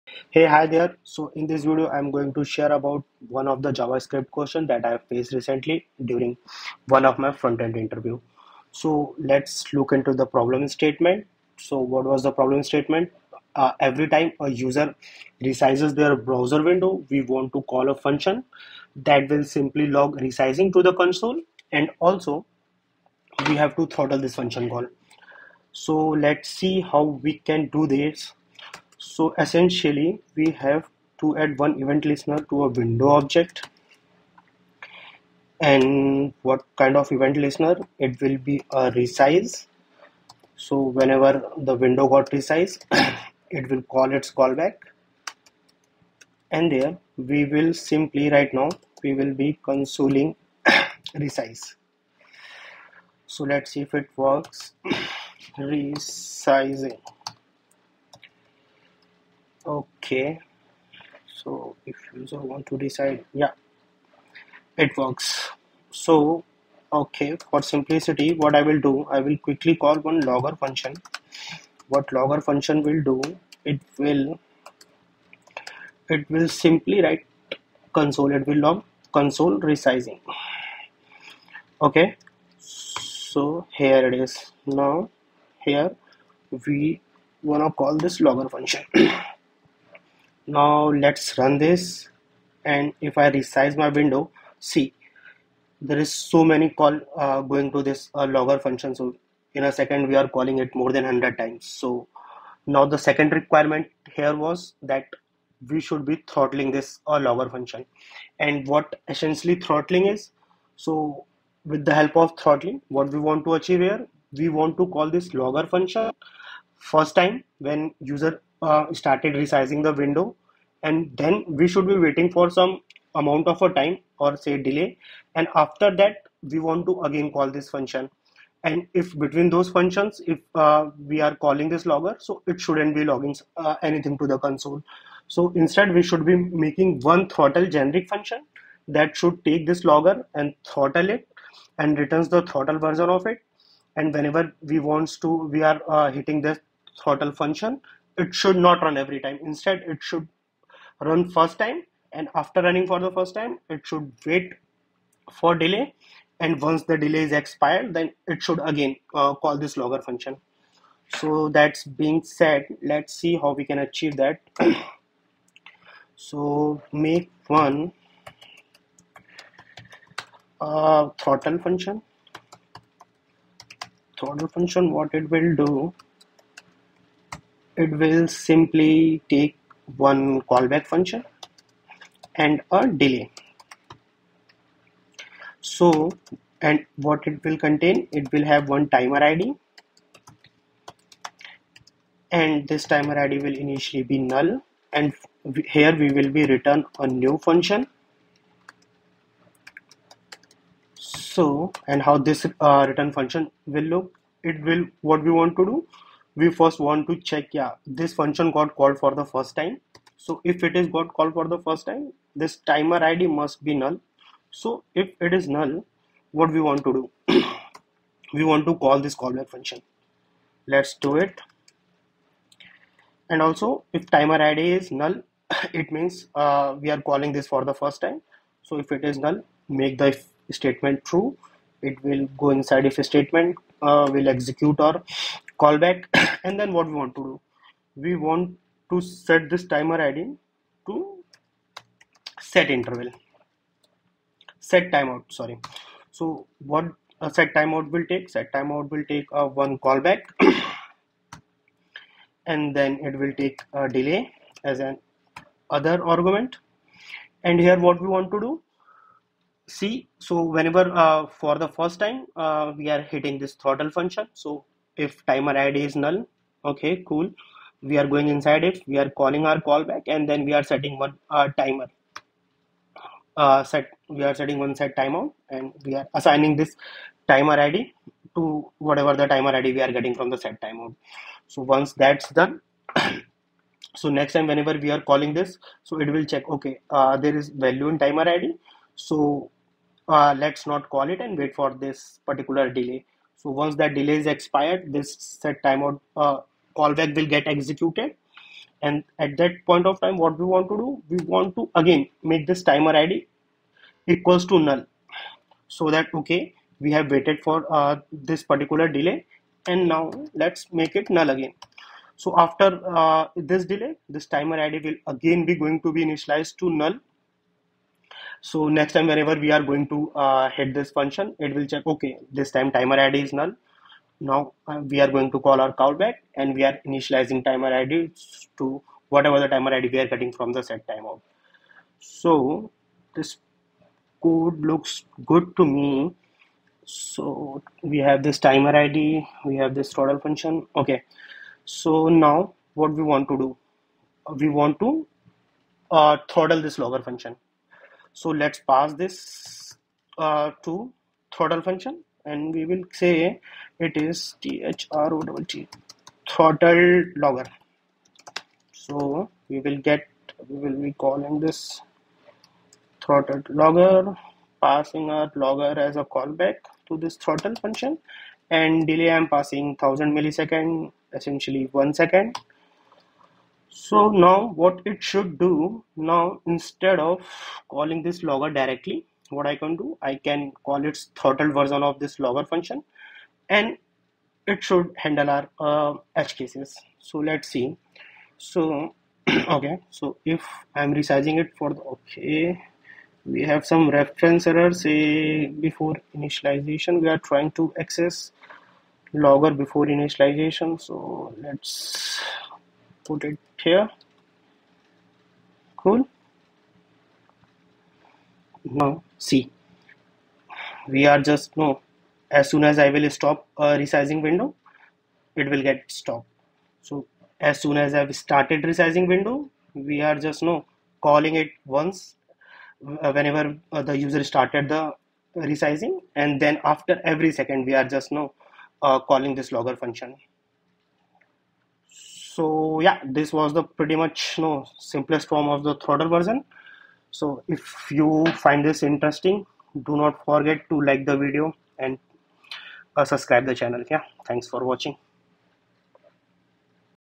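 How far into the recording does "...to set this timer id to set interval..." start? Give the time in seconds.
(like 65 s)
238 s.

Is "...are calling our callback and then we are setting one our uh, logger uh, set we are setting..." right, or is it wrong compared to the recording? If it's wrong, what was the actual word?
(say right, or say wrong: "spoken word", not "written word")
wrong: "timer", not "logger".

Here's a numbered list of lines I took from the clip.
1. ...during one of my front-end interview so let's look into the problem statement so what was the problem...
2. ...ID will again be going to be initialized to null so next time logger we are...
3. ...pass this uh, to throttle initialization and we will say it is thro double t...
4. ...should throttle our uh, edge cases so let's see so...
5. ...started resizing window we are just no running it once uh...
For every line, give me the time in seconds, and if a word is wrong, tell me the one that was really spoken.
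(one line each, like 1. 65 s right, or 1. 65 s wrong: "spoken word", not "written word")
1. 6 s right
2. 314 s wrong: "whenever", not "logger"
3. 348 s wrong: "function", not "initialization"
4. 384 s wrong: "handle", not "throttle"
5. 418 s wrong: "calling", not "running".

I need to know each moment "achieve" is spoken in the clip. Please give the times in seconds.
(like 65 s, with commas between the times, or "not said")
113 s, 163 s.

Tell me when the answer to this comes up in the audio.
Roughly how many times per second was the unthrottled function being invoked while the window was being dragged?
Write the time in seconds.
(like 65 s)
100 s.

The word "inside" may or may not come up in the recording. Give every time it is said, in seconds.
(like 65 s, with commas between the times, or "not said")
232 s, 268 s.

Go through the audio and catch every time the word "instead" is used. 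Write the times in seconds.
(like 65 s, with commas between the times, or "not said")
135 s, 149 s, 376 s.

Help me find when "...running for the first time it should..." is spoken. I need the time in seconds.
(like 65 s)
152 s.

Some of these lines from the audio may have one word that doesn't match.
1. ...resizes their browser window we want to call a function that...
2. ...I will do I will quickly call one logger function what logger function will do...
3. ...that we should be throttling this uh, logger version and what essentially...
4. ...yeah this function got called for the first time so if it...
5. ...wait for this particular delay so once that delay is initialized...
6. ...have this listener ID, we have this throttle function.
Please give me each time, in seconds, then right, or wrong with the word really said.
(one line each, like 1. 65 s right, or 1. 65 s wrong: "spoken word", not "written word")
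1. 15 s right
2. 68 s right
3. 104 s wrong: "function", not "version"
4. 207 s right
5. 291 s wrong: "expired", not "initialized"
6. 337 s wrong: "timer", not "listener".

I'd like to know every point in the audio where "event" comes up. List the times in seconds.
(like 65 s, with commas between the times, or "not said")
31 s, 37 s.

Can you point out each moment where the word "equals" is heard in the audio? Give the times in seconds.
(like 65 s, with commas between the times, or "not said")
304 s.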